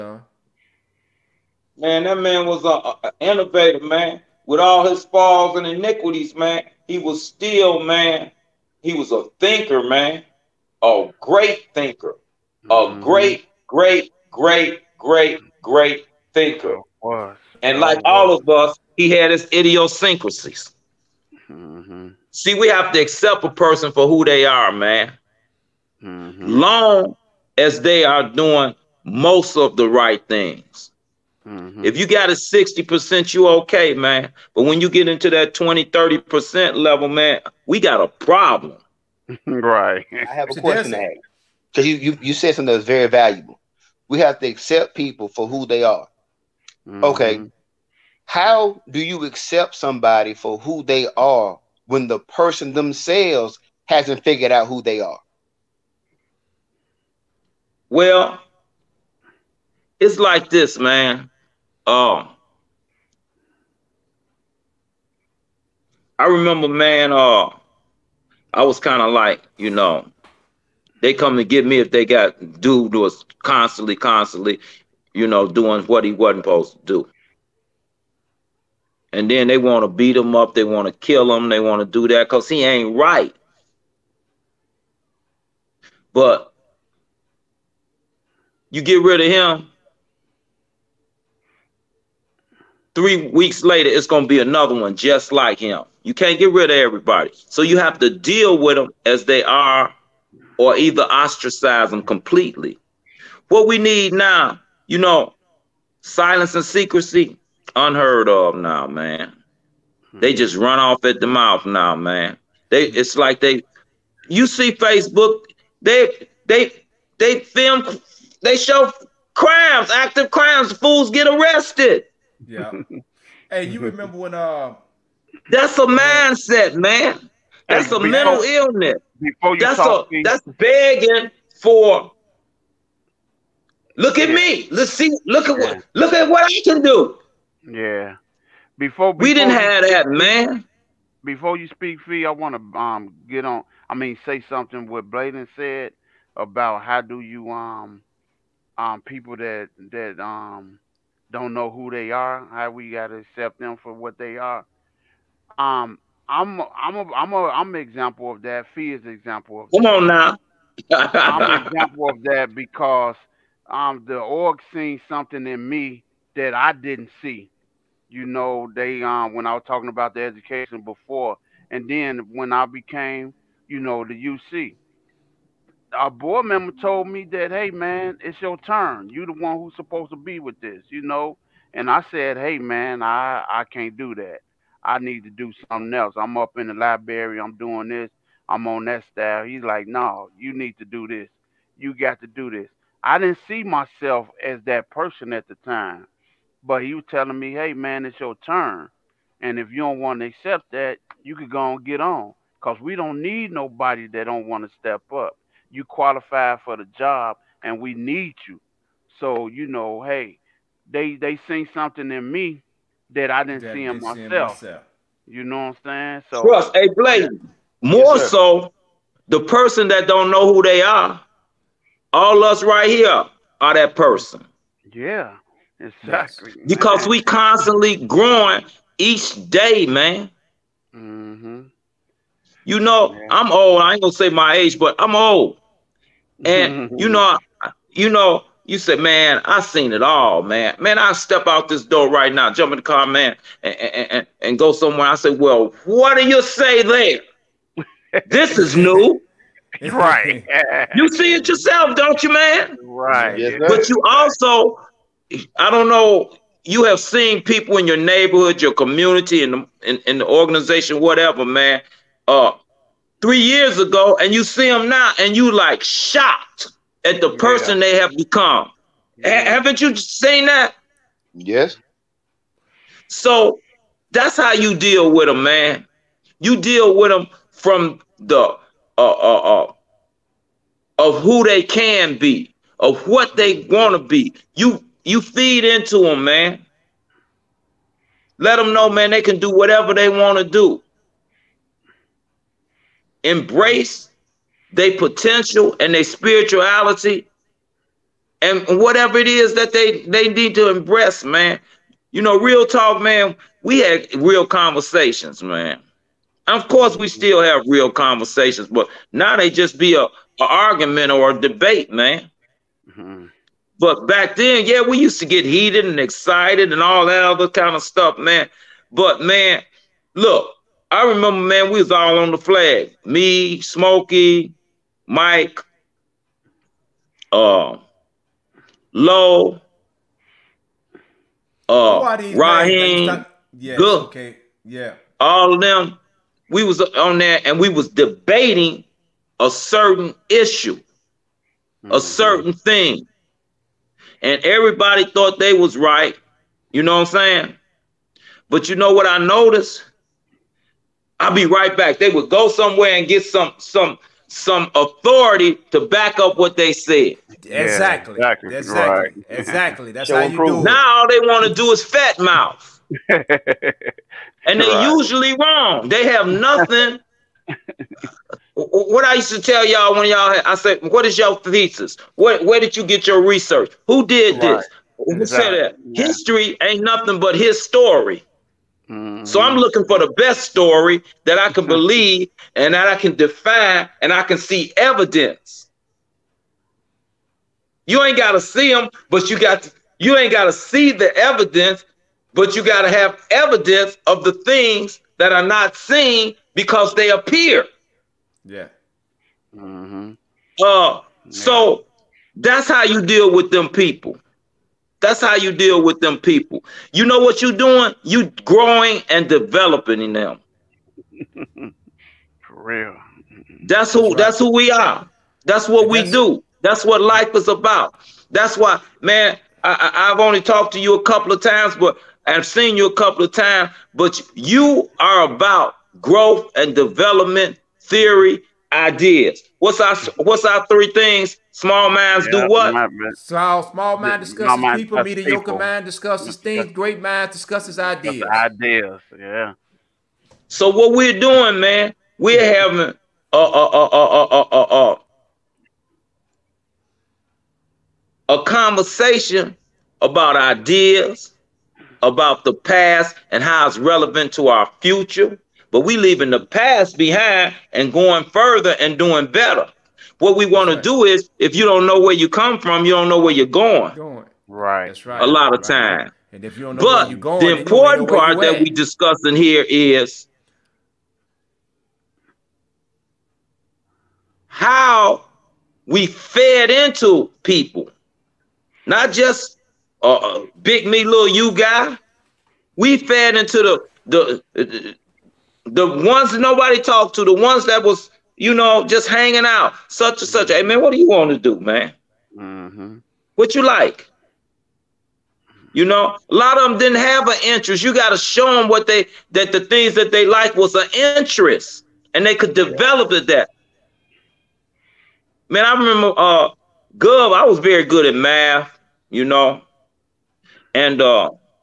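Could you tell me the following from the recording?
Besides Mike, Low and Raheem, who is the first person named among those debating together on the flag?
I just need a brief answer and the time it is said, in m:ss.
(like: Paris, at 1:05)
Smokey, at 5:23.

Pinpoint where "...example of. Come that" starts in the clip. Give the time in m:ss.
2:39.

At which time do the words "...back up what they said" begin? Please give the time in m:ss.
5:55.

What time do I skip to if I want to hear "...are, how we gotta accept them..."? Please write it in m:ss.
2:32.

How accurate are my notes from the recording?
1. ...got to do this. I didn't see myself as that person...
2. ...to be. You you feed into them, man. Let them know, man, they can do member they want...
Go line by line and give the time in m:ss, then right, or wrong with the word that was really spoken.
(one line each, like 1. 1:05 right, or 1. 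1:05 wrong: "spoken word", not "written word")
1. 3:11 right
2. 4:43 wrong: "whatever", not "member".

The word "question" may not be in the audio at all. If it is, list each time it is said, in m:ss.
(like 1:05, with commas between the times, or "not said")
0:40.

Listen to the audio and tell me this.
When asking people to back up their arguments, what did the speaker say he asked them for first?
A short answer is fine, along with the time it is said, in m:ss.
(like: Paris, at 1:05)
thesis, at 6:11.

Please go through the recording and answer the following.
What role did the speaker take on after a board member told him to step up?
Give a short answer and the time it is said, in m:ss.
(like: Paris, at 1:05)
UC, at 2:54.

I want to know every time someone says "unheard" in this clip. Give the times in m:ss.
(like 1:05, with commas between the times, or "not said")
1:47.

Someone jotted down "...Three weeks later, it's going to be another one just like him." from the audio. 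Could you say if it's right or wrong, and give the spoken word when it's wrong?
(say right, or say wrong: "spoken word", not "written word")
right.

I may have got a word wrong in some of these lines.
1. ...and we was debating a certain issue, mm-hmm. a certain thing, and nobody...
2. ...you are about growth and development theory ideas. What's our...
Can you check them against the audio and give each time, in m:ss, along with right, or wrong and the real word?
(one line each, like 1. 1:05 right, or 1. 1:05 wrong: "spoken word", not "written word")
1. 5:37 wrong: "everybody", not "nobody"
2. 7:04 right.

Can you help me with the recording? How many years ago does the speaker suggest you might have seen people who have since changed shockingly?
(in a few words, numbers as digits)
3.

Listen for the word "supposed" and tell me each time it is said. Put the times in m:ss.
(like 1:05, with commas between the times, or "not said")
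1:16, 2:59.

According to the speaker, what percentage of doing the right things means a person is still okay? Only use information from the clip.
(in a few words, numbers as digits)
60%.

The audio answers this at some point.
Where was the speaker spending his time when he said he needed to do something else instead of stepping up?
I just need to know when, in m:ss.
3:06.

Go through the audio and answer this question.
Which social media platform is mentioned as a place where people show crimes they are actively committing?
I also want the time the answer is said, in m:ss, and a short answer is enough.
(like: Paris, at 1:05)
Facebook, at 1:54.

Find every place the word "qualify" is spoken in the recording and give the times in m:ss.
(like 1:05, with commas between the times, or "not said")
3:25.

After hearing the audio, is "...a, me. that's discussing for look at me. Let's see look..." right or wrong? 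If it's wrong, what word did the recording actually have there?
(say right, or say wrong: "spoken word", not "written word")
wrong: "begging", not "discussing".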